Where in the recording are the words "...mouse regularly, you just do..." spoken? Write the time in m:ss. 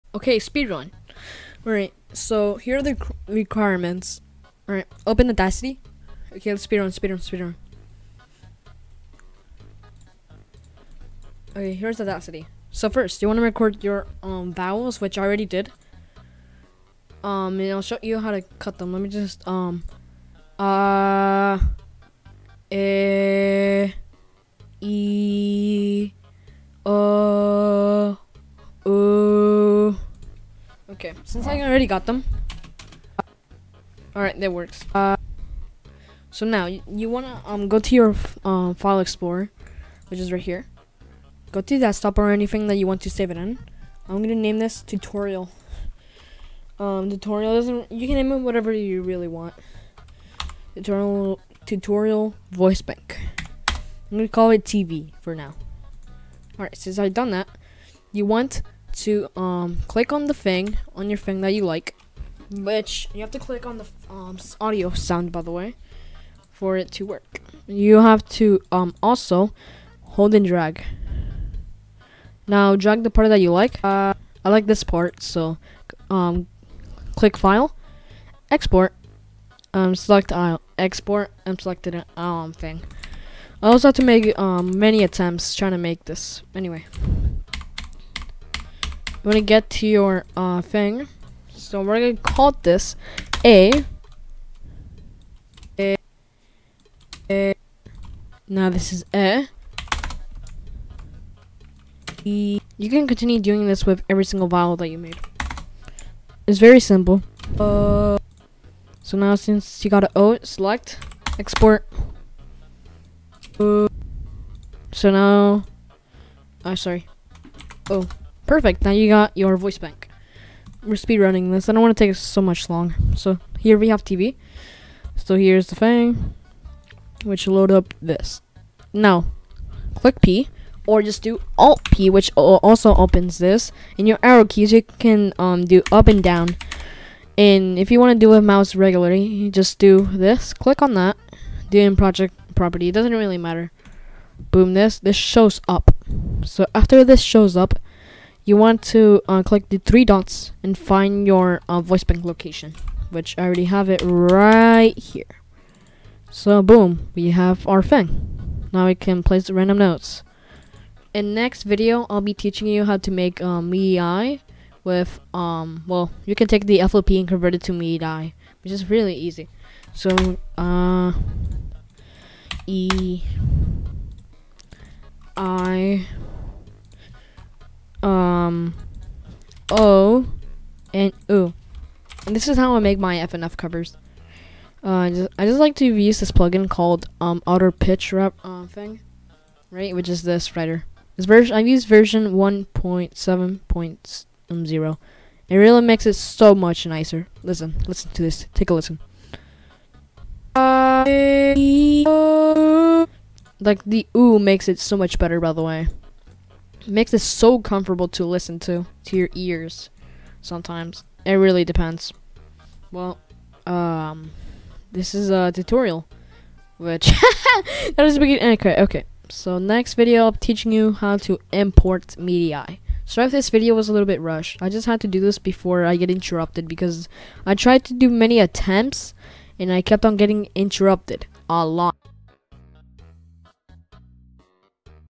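2:18.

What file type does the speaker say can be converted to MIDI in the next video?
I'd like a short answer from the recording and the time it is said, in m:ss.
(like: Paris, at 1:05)
FLP, at 2:46.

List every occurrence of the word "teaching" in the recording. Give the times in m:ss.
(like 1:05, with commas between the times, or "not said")
2:42, 3:40.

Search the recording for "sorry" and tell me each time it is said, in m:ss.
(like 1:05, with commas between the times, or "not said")
1:56, 3:43.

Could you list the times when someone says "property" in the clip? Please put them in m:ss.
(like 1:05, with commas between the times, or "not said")
2:22.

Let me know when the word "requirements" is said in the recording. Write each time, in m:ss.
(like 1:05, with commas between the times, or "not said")
0:03.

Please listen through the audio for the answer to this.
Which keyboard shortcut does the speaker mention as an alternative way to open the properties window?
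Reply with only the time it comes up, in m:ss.
2:11.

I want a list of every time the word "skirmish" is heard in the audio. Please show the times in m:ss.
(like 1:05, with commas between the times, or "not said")
not said.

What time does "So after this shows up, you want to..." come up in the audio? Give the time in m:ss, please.
2:26.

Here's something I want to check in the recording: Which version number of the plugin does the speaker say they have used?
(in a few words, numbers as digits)
1.7.0.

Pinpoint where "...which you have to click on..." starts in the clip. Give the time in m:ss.
1:02.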